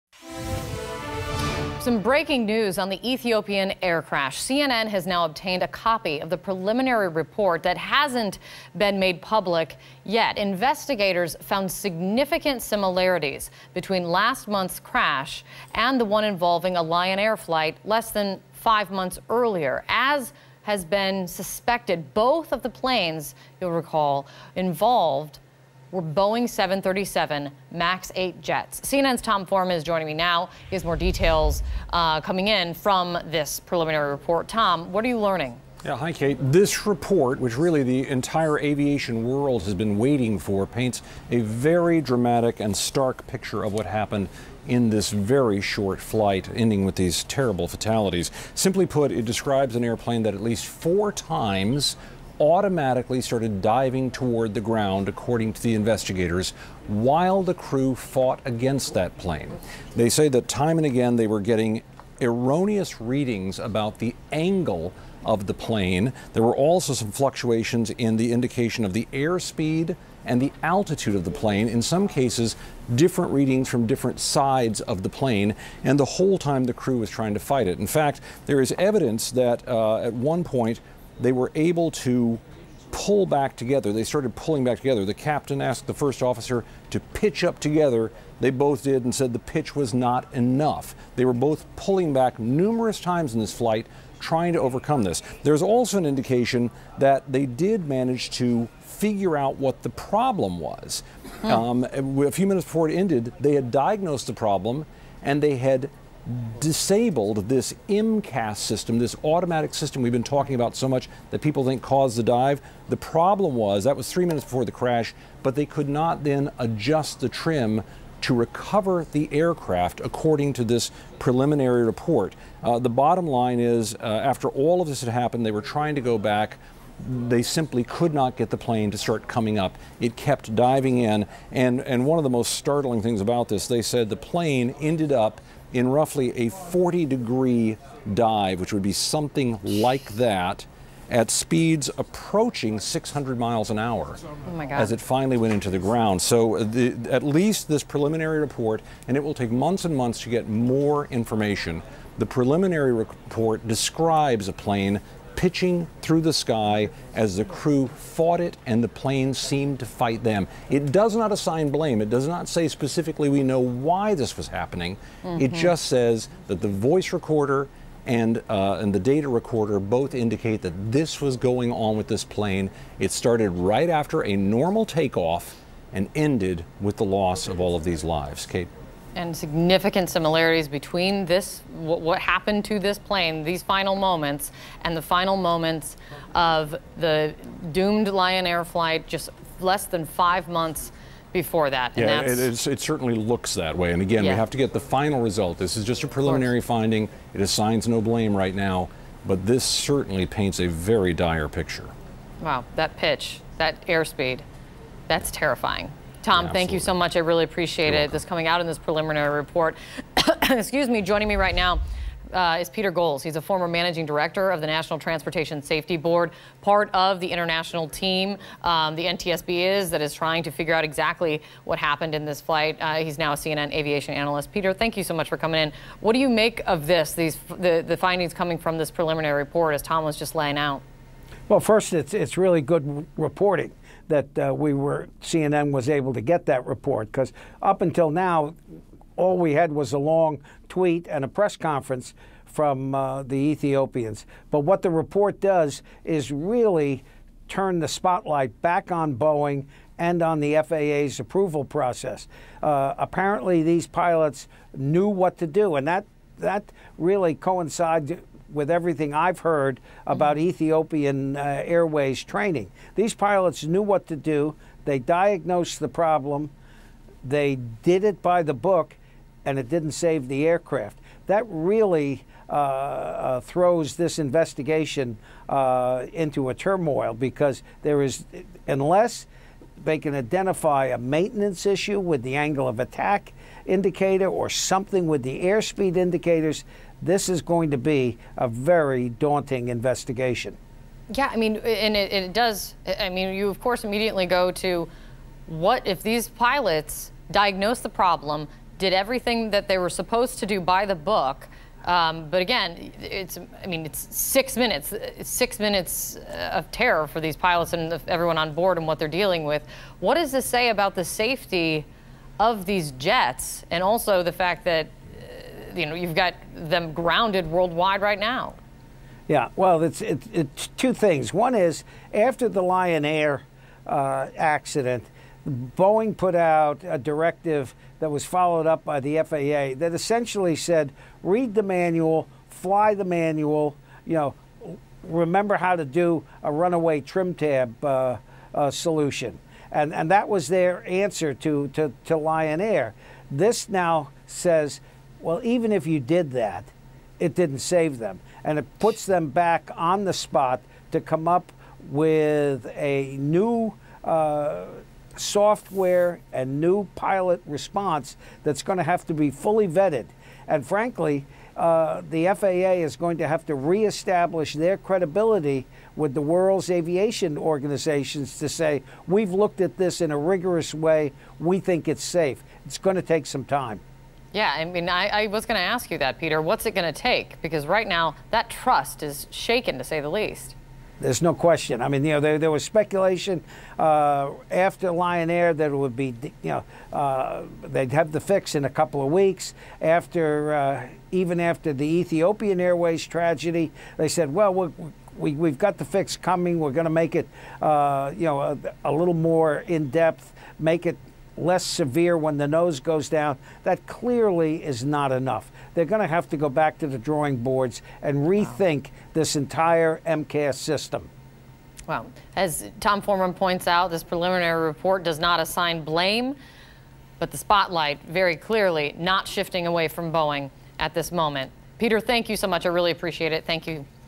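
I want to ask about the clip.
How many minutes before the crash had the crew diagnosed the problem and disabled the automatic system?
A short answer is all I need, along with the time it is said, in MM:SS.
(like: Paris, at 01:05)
3, at 01:54.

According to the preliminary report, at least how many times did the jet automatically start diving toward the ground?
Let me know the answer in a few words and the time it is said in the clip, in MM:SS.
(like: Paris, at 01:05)
4, at 00:50.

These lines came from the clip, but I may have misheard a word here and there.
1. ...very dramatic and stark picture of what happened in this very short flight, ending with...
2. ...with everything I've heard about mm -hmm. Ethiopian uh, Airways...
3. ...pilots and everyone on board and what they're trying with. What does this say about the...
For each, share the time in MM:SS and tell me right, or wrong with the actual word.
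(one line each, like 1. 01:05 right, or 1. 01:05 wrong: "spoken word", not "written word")
1. 00:41 right
2. 04:18 right
3. 05:07 wrong: "dealing", not "trying".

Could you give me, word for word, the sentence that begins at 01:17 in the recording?
In fact, there is evidence that uh, at one point they were able to pull back together.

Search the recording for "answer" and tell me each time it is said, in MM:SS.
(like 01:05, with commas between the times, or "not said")
05:40.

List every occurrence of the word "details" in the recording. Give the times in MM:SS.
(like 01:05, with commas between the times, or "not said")
00:30.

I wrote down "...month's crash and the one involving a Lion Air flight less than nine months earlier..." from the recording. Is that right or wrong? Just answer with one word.
wrong.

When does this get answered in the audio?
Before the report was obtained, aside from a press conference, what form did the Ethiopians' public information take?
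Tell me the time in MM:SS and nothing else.
03:59.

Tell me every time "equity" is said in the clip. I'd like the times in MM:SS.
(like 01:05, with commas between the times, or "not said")
not said.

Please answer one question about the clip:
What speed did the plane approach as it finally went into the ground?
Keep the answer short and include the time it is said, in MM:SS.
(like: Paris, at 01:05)
600 miles an hour, at 02:22.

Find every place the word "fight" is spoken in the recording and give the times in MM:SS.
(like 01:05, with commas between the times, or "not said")
01:17, 02:39.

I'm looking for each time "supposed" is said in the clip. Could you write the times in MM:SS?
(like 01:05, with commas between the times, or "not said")
04:59.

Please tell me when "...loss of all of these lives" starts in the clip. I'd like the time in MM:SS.
02:57.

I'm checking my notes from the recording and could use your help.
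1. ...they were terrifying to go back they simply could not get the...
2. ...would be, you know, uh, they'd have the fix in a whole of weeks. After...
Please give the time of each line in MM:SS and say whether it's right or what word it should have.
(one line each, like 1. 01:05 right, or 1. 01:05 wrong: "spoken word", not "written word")
1. 02:05 wrong: "trying", not "terrifying"
2. 06:25 wrong: "couple", not "whole".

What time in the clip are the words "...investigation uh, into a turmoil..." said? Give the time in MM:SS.
04:34.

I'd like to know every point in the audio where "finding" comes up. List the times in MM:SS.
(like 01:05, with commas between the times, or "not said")
03:16, 03:47.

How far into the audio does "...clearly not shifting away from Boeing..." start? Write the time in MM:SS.
06:58.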